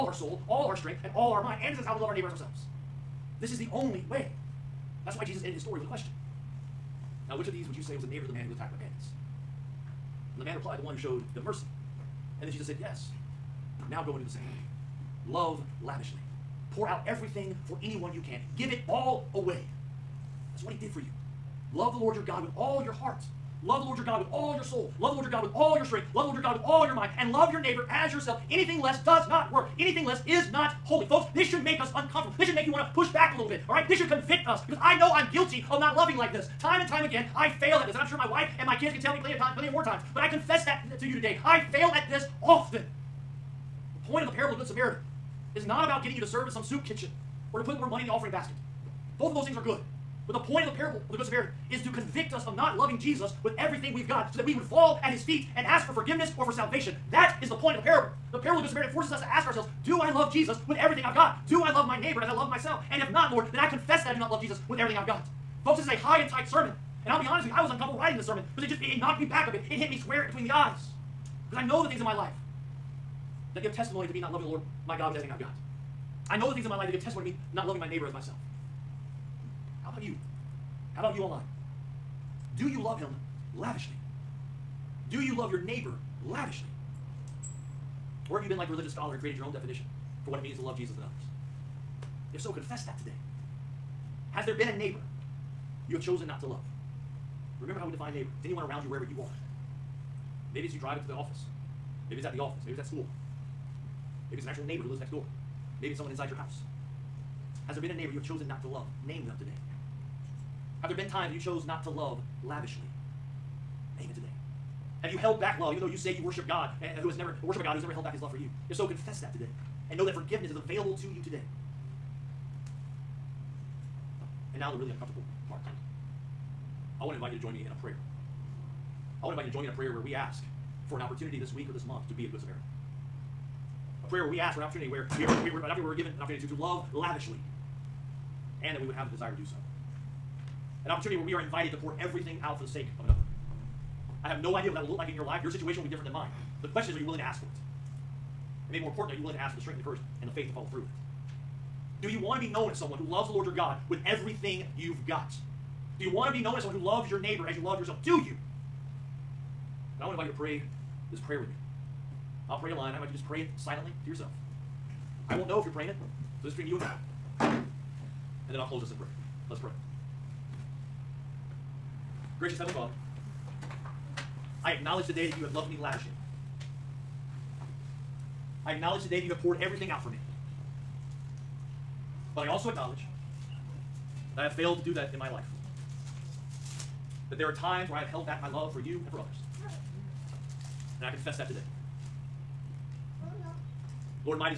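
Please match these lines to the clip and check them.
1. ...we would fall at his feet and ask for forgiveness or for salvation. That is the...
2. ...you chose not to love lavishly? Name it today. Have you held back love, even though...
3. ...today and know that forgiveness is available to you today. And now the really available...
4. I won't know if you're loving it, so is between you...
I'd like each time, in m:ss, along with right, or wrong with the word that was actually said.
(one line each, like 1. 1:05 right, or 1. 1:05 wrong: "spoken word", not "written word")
1. 0:54 right
2. 1:51 right
3. 1:59 wrong: "uncomfortable", not "available"
4. 2:45 wrong: "praying", not "loving".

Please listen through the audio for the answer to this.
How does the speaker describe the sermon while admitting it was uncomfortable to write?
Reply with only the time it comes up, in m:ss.
1:05.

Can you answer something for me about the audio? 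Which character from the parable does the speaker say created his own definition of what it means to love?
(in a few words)
The religious scholar.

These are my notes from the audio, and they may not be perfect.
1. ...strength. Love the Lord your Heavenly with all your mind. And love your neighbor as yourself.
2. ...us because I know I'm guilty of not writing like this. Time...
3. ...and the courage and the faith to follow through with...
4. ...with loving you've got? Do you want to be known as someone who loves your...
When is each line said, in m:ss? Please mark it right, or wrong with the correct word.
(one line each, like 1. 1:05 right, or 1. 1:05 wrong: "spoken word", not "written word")
1. 0:25 wrong: "God", not "Heavenly"
2. 0:34 wrong: "loving", not "writing"
3. 2:29 right
4. 2:33 wrong: "everything", not "loving".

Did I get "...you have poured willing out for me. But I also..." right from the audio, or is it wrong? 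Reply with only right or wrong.
wrong.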